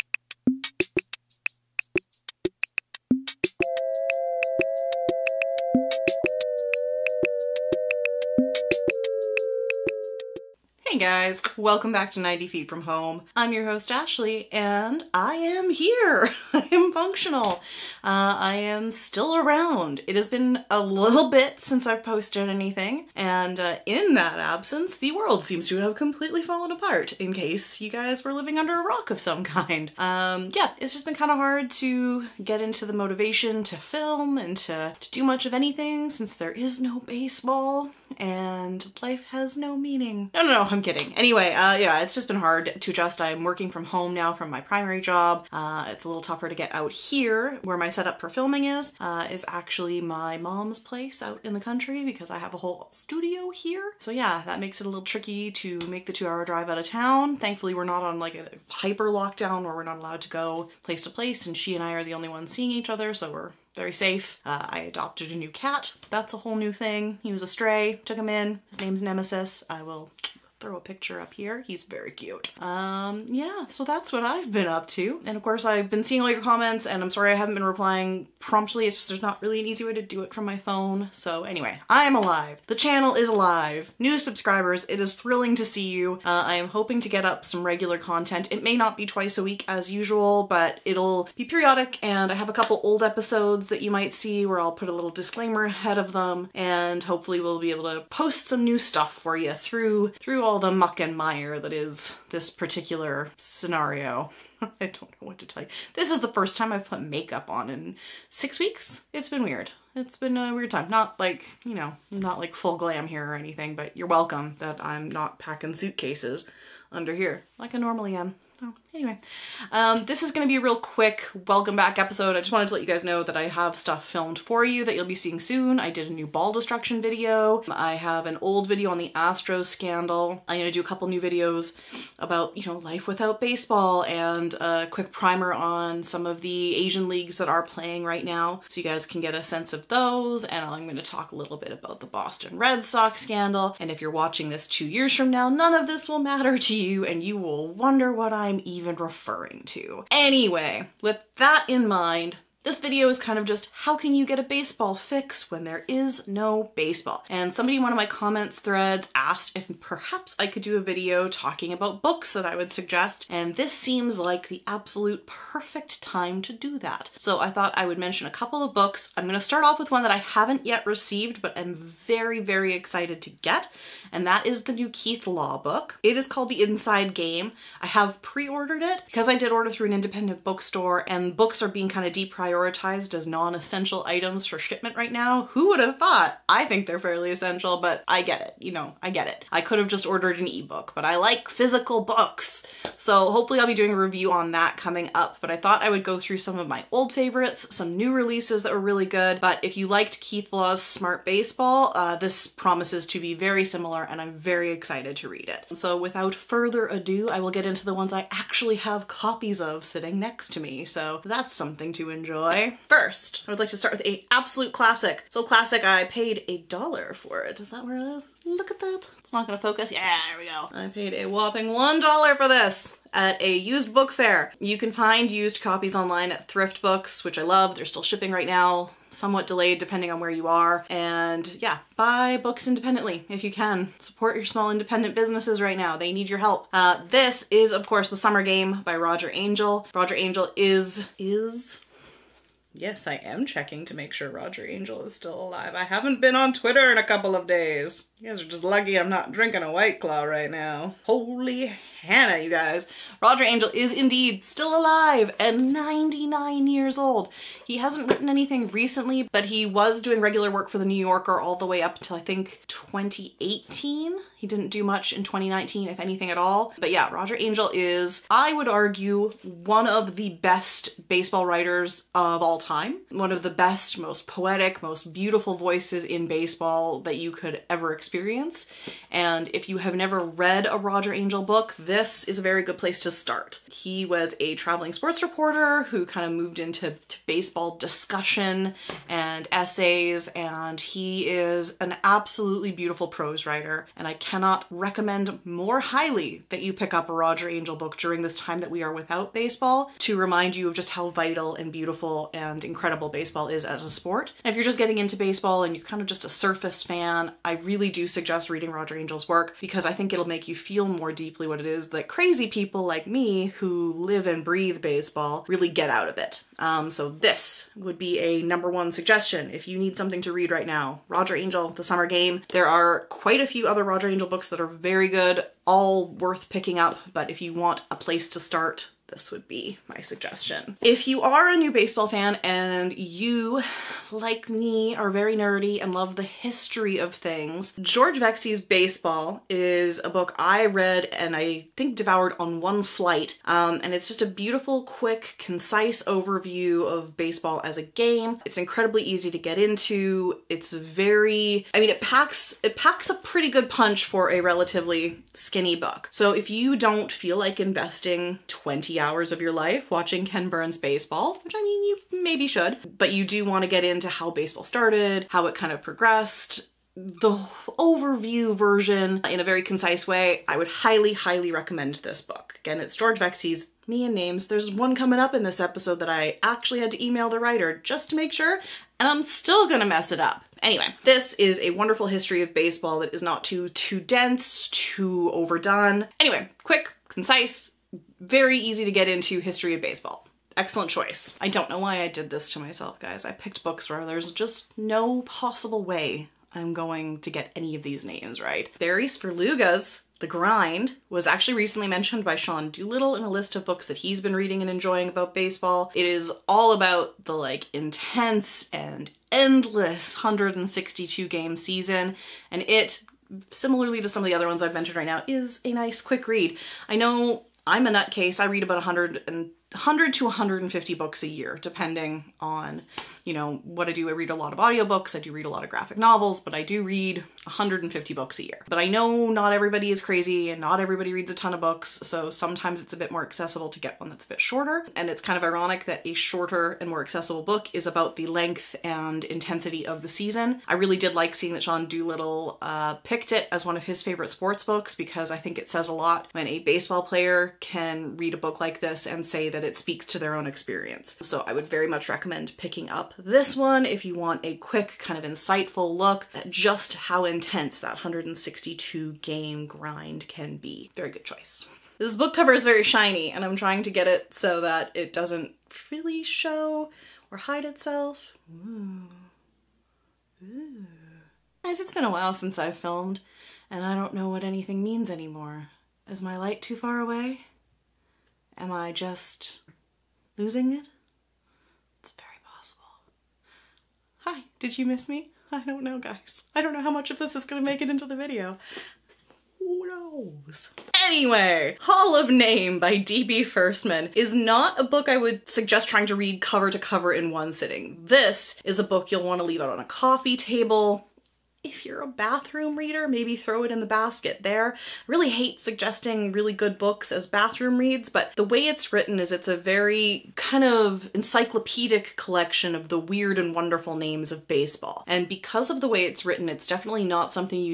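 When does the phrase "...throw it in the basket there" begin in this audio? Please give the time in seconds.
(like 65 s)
503 s.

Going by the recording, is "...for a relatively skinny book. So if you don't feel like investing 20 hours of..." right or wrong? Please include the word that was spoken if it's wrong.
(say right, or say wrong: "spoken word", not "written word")
right.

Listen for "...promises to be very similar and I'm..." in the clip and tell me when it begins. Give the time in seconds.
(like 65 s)
202 s.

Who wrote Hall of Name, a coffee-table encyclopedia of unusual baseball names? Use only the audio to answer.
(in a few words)
D.B. Firstman.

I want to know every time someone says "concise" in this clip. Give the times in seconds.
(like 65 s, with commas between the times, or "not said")
345 s, 369 s, 387 s.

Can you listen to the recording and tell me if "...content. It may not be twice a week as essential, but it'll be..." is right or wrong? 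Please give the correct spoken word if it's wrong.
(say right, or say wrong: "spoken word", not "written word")
wrong: "usual", not "essential".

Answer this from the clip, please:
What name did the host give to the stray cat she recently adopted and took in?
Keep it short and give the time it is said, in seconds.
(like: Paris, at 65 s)
Nemesis, at 69 s.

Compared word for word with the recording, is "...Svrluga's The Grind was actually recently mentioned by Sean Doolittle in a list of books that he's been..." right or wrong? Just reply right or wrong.
right.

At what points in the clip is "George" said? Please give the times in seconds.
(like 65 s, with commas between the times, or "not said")
337 s, 372 s.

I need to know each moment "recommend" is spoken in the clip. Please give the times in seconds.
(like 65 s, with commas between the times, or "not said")
294 s, 371 s, 452 s.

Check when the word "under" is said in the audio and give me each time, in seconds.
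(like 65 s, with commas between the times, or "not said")
28 s, 116 s.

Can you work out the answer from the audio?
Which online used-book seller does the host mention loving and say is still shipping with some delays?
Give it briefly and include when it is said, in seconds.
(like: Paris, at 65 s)
Thrift Books, at 226 s.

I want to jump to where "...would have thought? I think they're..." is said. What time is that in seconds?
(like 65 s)
185 s.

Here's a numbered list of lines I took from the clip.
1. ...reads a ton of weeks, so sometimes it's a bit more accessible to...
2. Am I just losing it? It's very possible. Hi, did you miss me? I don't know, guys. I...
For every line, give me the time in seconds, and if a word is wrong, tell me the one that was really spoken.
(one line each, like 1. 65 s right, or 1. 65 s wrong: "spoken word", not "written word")
1. 431 s wrong: "books", not "weeks"
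2. 478 s right.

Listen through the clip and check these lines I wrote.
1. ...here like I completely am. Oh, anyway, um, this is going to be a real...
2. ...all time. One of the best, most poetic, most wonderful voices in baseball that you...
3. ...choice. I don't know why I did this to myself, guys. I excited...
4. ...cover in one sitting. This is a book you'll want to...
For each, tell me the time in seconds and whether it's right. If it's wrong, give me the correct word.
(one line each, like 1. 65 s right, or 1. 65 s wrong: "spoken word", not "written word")
1. 117 s wrong: "normally", not "completely"
2. 272 s wrong: "beautiful", not "wonderful"
3. 390 s wrong: "picked", not "excited"
4. 496 s right.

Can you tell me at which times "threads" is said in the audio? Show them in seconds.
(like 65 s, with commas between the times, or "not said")
158 s.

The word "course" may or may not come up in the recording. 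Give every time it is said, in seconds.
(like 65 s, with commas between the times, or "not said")
75 s, 237 s.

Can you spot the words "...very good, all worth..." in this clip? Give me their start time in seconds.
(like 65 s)
324 s.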